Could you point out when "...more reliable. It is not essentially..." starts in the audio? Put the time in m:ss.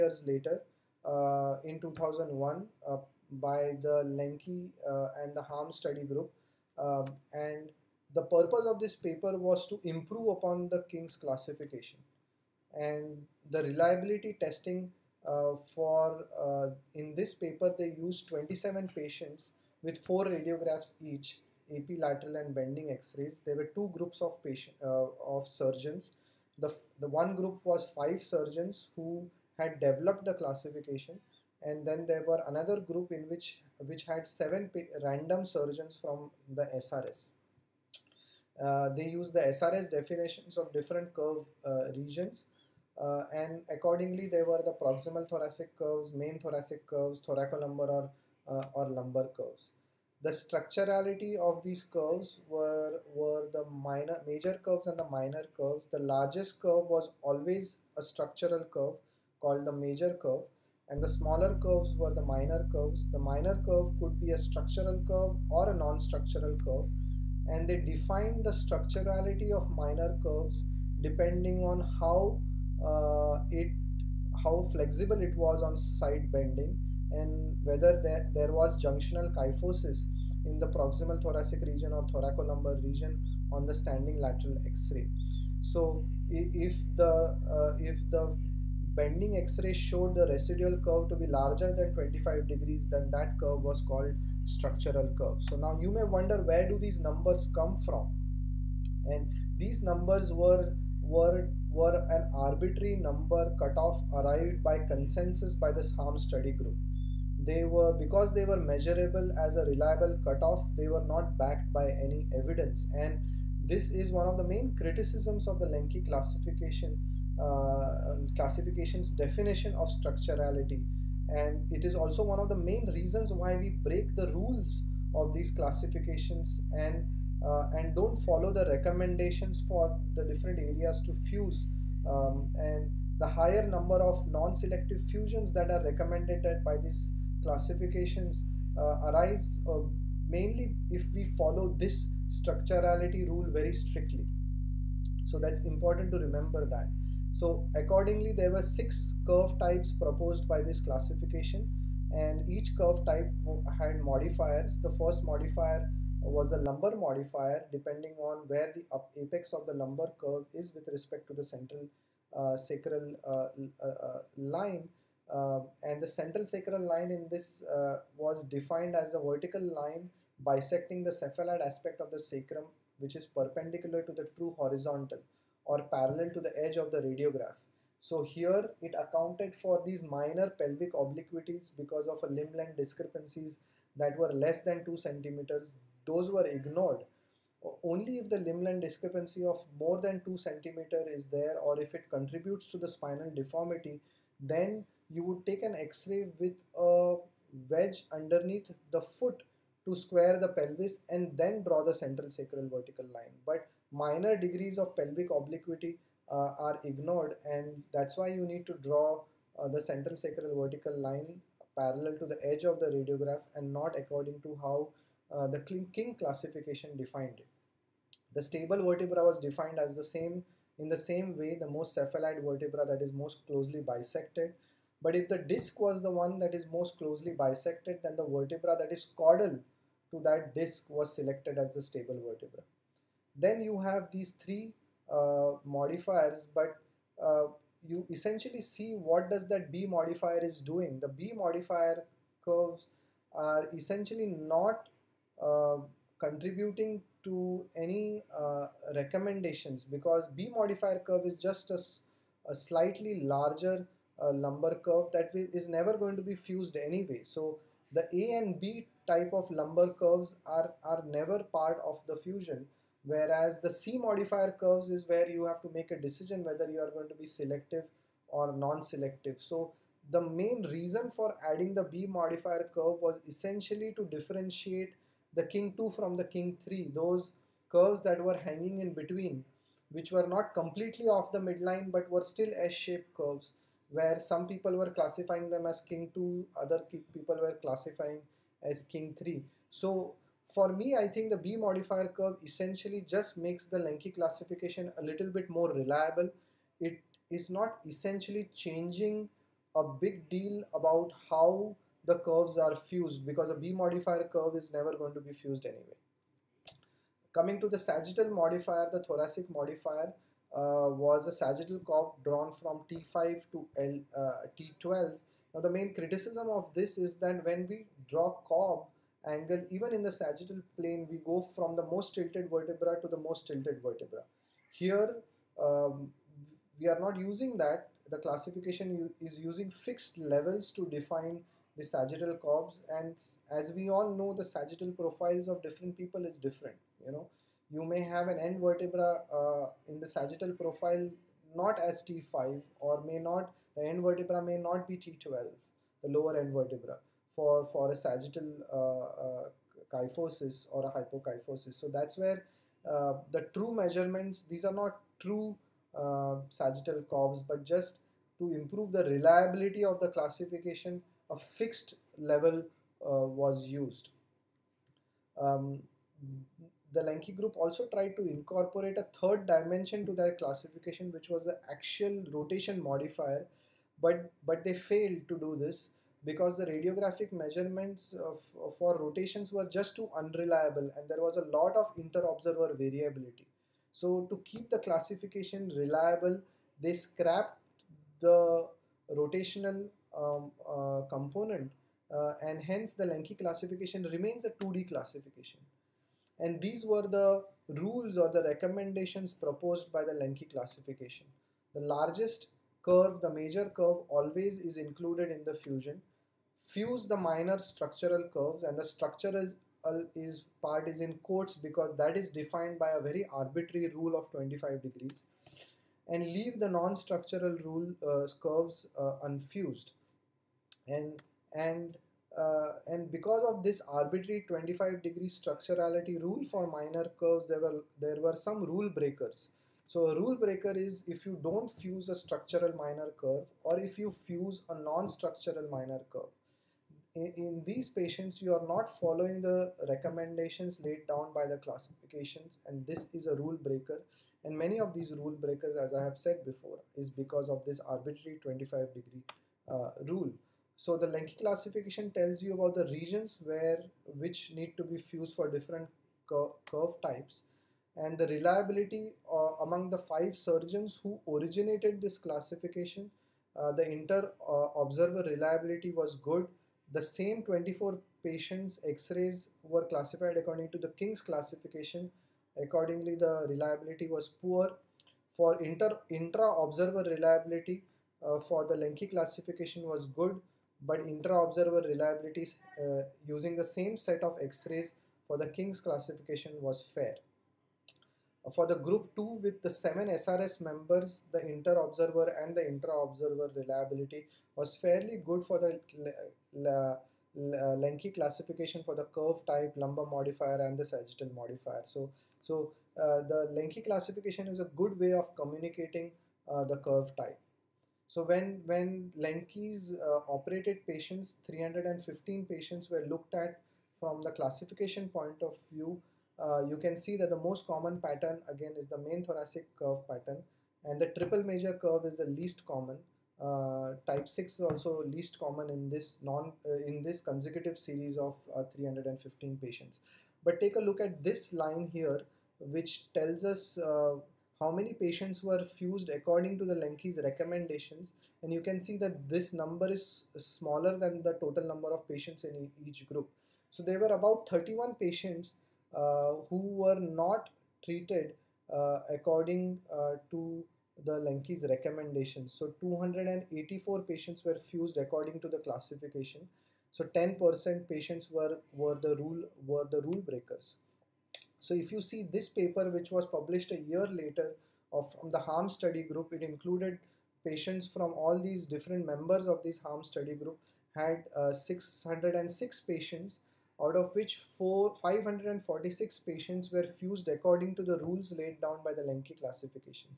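4:55.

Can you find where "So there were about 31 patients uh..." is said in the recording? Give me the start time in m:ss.
9:03.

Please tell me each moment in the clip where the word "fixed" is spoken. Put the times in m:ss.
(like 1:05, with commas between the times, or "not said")
5:29, 6:01.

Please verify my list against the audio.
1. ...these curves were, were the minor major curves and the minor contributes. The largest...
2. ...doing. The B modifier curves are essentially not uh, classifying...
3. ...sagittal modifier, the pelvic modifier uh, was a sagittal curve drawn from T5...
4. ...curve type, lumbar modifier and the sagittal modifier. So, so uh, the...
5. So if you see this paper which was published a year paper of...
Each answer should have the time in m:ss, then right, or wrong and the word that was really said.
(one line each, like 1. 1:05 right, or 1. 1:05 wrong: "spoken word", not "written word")
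1. 0:51 wrong: "curves", not "contributes"
2. 4:00 wrong: "contributing", not "classifying"
3. 5:07 wrong: "thoracic", not "pelvic"
4. 8:19 right
5. 9:21 wrong: "later", not "paper".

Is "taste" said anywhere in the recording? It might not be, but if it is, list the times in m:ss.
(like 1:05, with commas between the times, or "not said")
not said.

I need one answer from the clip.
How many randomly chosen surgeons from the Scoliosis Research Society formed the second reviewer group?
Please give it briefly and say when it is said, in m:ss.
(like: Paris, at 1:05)
7, at 0:34.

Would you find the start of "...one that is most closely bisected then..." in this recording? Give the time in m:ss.
3:46.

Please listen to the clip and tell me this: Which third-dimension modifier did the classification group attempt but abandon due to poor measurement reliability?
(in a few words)
Axial rotation modifier.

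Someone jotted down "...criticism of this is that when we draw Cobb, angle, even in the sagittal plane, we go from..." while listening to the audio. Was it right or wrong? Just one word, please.
right.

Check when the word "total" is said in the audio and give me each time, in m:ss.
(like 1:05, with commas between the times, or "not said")
9:01.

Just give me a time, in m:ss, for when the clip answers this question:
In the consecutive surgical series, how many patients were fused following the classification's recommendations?
9:12.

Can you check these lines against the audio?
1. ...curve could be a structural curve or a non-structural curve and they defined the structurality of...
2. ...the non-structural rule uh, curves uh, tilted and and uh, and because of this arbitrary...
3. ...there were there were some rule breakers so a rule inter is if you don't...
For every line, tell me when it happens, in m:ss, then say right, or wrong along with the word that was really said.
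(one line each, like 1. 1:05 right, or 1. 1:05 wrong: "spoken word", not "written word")
1. 1:03 right
2. 6:56 wrong: "unfused", not "tilted"
3. 7:07 wrong: "breaker", not "inter".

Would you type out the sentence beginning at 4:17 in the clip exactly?
So the A and B type of lumbar curves are, are never part of the fusion.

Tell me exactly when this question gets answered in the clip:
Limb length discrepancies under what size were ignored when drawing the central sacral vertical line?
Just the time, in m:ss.
3:04.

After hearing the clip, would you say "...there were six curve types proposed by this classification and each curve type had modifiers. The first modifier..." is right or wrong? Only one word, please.
right.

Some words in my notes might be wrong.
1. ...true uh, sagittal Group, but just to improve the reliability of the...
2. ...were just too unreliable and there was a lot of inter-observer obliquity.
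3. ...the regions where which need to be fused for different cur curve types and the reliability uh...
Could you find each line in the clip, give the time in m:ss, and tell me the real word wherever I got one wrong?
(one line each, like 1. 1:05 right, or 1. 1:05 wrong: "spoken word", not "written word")
1. 5:55 wrong: "Cobbs", not "Group"
2. 6:19 wrong: "variability", not "obliquity"
3. 7:32 right.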